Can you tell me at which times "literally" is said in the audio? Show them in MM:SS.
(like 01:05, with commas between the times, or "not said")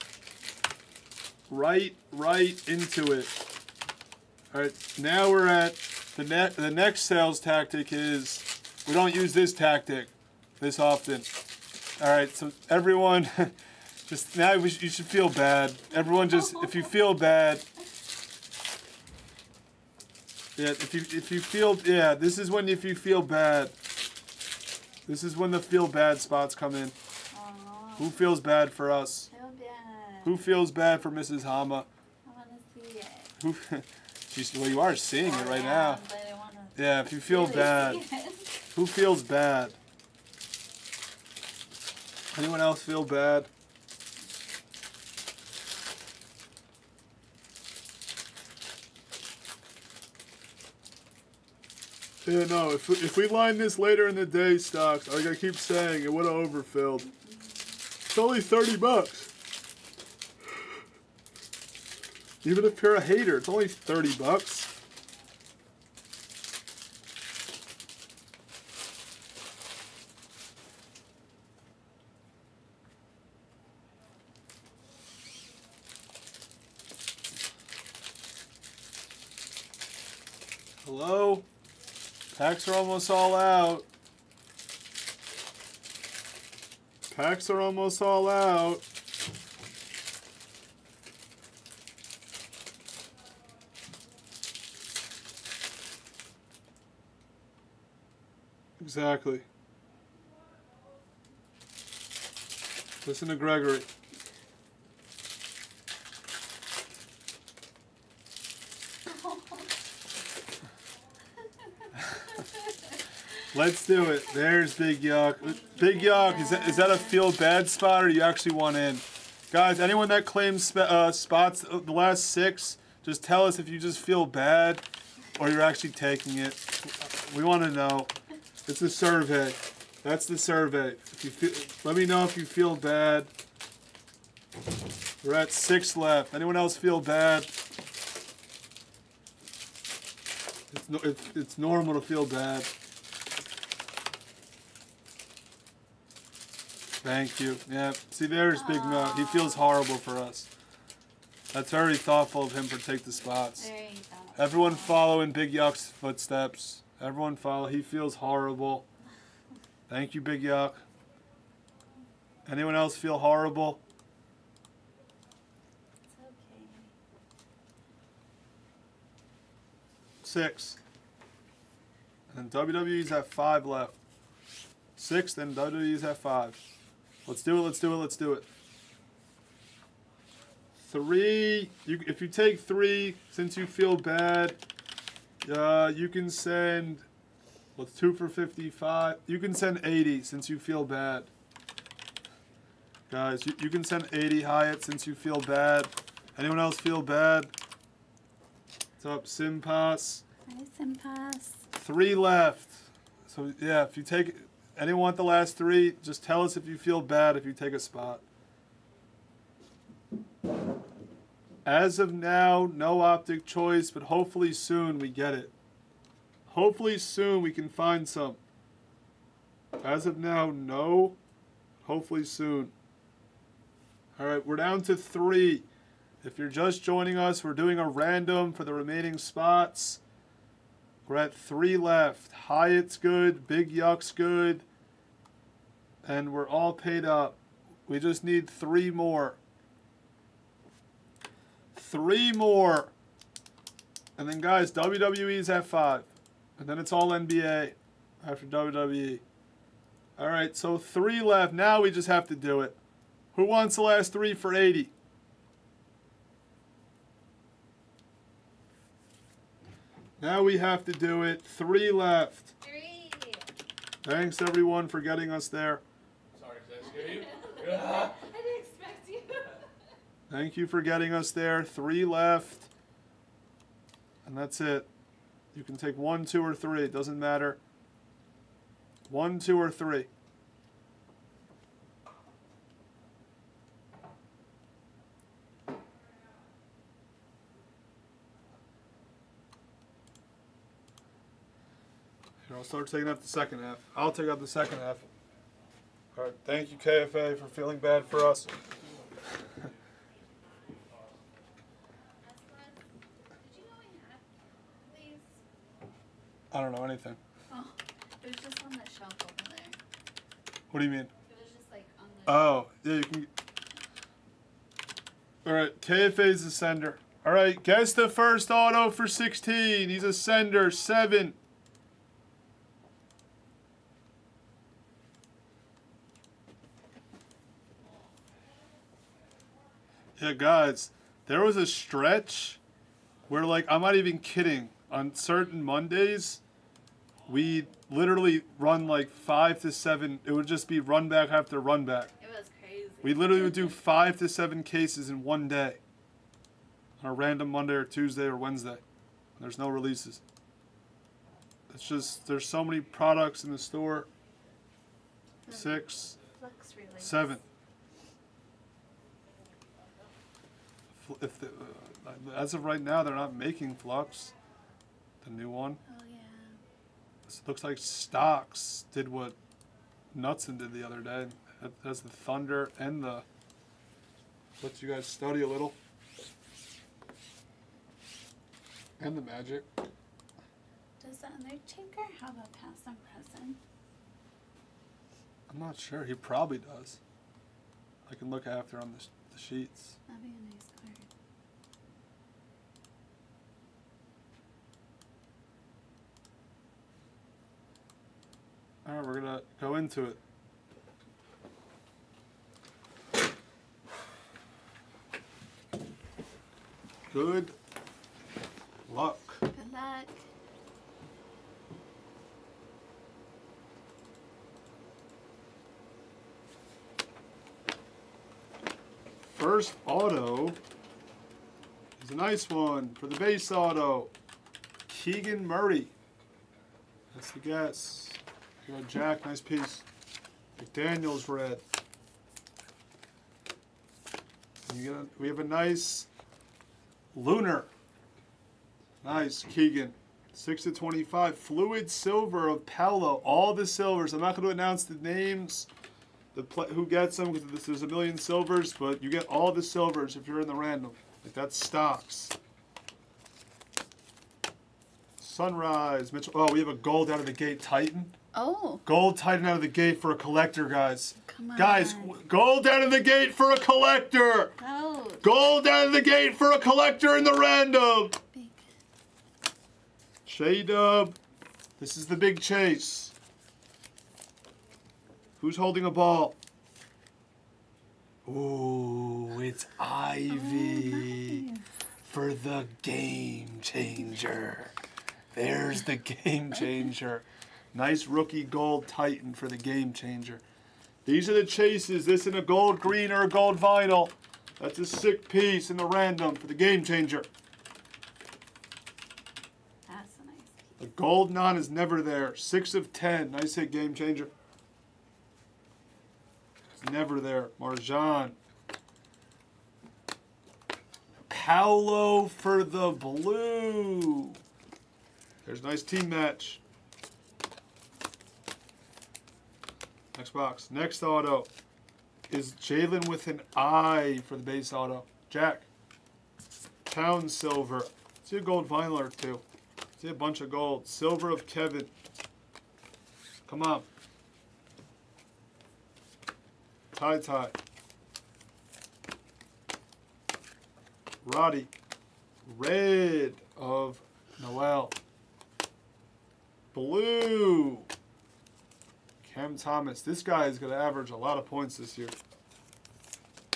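05:37, 05:43.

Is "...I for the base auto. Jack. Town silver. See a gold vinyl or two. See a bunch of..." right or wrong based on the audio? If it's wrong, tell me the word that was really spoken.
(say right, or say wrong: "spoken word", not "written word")
right.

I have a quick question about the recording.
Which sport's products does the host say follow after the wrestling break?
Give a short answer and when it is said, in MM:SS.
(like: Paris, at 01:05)
NBA, at 04:06.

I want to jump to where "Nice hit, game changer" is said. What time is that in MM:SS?
08:23.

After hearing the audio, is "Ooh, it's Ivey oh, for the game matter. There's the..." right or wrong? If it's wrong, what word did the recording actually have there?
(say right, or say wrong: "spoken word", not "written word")
wrong: "changer", not "matter".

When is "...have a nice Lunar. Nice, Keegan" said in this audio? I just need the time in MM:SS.
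07:15.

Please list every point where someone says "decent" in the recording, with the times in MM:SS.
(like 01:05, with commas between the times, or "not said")
not said.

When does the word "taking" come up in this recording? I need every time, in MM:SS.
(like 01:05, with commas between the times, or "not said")
02:05, 04:52.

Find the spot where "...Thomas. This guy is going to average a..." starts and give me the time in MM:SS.
09:09.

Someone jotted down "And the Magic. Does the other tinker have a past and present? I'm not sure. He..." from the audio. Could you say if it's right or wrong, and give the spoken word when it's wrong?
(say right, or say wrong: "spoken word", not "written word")
right.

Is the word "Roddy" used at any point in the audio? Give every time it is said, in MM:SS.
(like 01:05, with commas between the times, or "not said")
09:01.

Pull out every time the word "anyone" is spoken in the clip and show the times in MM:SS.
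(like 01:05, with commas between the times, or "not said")
00:42, 01:59, 02:16, 02:42, 03:16, 03:24.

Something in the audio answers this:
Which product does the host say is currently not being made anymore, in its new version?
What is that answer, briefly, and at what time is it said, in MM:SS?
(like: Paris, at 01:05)
Flux, at 06:03.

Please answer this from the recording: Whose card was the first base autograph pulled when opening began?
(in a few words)
Keegan Murray.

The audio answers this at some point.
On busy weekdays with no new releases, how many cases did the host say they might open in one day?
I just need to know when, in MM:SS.
05:43.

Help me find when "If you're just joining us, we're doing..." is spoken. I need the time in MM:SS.
03:46.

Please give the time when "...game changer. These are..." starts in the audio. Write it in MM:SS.
08:09.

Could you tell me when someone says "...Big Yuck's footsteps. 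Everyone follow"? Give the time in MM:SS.
02:35.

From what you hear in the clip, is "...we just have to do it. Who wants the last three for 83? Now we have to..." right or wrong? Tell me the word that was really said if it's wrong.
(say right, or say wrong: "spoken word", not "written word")
wrong: "80", not "83".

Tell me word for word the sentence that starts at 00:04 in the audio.
All right, now we're at the, net.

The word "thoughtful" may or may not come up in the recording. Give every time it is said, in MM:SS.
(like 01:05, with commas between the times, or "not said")
02:31.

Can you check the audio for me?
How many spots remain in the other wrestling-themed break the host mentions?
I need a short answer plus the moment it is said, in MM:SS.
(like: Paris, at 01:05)
5, at 02:52.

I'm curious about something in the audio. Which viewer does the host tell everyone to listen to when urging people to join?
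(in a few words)
Gregory.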